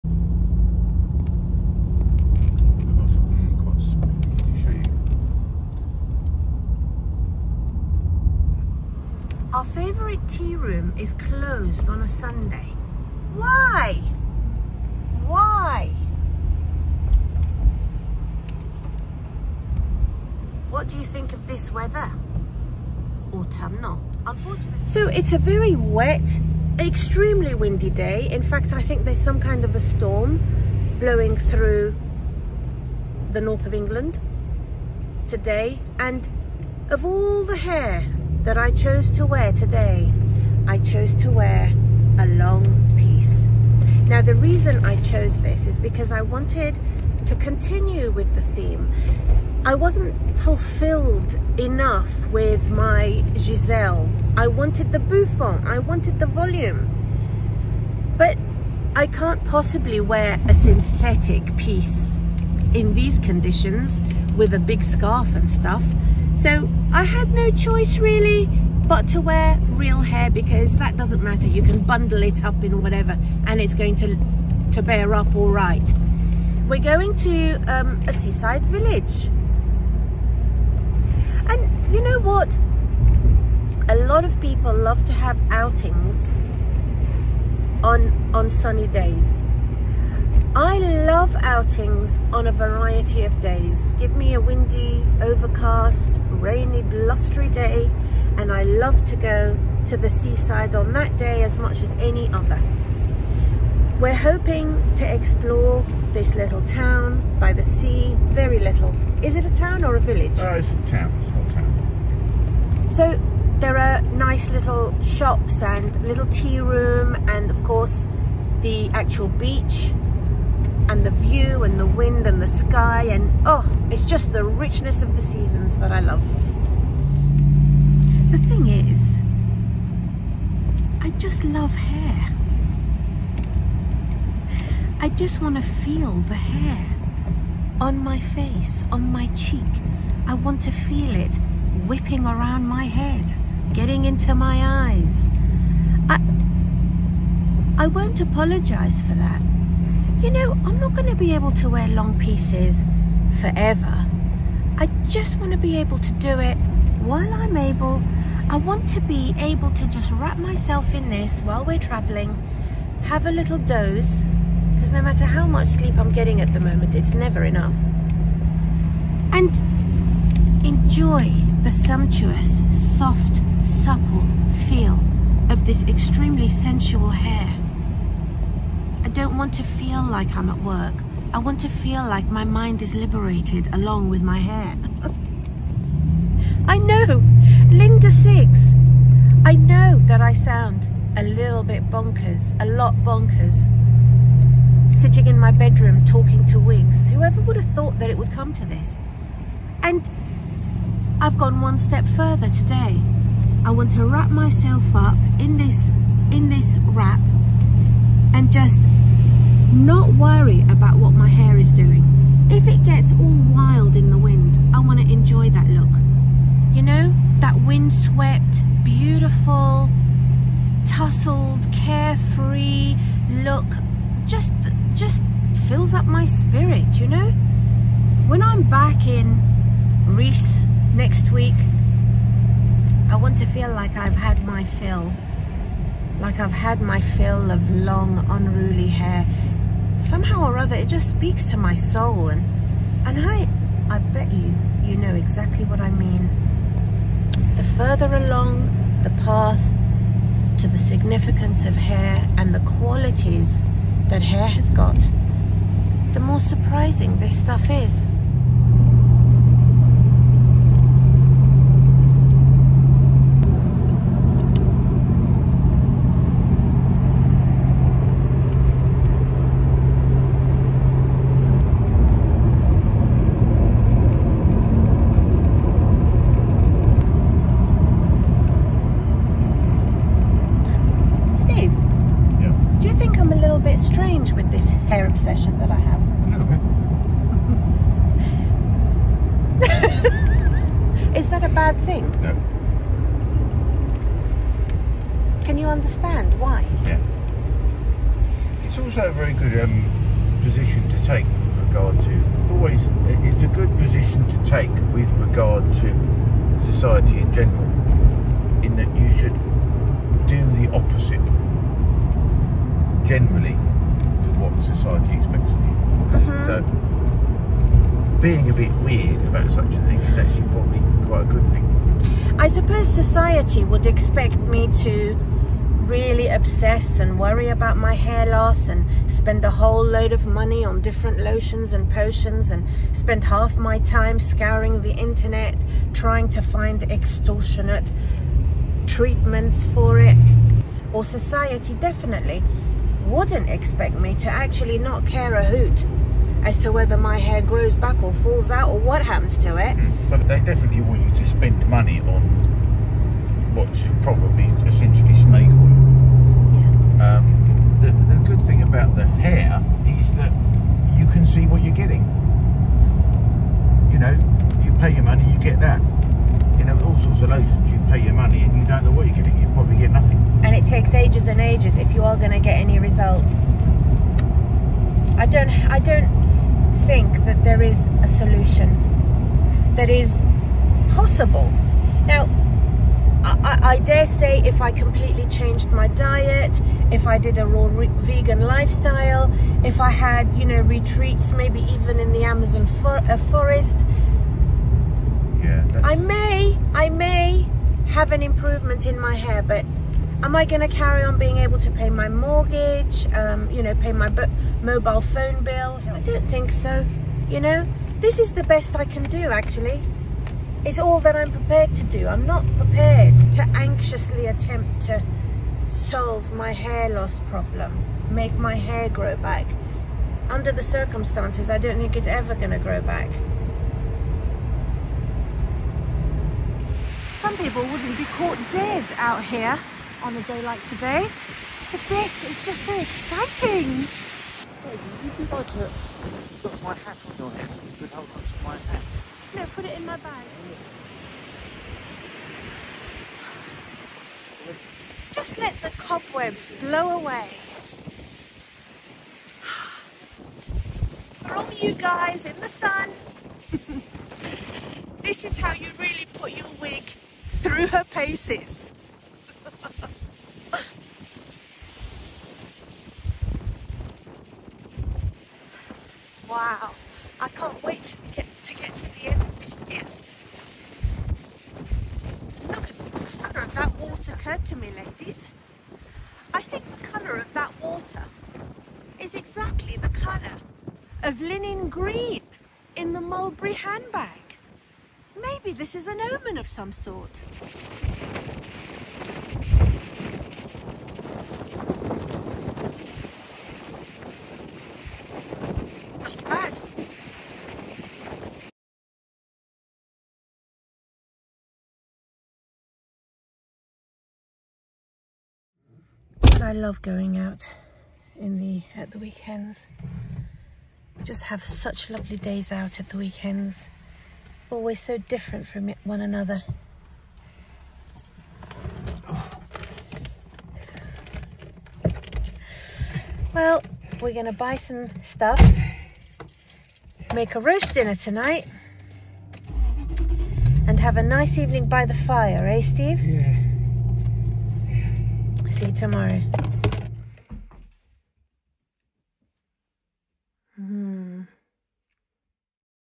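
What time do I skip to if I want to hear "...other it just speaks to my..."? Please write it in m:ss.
4:00.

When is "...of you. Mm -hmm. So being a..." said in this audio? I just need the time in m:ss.
5:15.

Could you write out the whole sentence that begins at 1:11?
You can bundle it up in whatever and it's going to, to bear up all right.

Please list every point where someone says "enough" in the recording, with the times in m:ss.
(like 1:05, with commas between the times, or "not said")
0:51, 2:47.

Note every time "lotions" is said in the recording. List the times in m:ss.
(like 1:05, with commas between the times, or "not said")
5:31, 6:07.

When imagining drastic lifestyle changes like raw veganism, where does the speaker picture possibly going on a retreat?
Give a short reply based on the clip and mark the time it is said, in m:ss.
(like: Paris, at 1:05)
The Amazon, at 6:32.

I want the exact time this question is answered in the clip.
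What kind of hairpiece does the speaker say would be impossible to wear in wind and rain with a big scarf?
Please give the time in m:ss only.
1:00.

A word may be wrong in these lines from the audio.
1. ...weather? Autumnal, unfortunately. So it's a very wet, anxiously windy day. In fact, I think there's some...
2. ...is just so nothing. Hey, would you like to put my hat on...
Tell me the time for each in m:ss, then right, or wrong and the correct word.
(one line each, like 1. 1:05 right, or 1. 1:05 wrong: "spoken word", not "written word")
1. 0:21 wrong: "extremely", not "anxiously"
2. 7:12 wrong: "exciting", not "nothing".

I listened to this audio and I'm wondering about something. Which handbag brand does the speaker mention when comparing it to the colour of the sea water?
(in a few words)
Mulberry.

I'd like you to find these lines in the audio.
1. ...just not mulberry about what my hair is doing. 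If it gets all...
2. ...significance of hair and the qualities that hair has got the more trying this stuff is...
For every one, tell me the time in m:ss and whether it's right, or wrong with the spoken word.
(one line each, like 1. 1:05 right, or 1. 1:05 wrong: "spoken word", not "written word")
1. 3:28 wrong: "worry", not "mulberry"
2. 4:10 wrong: "surprising", not "trying".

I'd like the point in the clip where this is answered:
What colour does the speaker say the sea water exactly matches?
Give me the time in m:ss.
8:01.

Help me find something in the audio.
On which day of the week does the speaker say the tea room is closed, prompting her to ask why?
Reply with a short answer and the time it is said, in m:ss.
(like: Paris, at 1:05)
Sunday, at 0:12.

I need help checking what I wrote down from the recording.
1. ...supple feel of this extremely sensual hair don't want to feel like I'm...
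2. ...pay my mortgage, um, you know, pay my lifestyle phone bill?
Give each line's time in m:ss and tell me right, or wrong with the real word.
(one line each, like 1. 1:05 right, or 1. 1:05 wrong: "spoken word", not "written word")
1. 2:53 right
2. 6:41 wrong: "mobile", not "lifestyle".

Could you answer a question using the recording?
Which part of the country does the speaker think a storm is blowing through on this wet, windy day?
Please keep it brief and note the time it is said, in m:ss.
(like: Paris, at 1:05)
the north of England, at 0:33.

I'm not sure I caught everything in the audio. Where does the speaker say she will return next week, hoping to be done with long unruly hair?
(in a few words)
Reese.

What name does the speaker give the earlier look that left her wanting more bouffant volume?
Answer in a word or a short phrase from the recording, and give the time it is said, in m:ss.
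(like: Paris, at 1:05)
Giselle, at 0:53.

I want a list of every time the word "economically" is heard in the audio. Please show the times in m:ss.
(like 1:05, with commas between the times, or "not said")
not said.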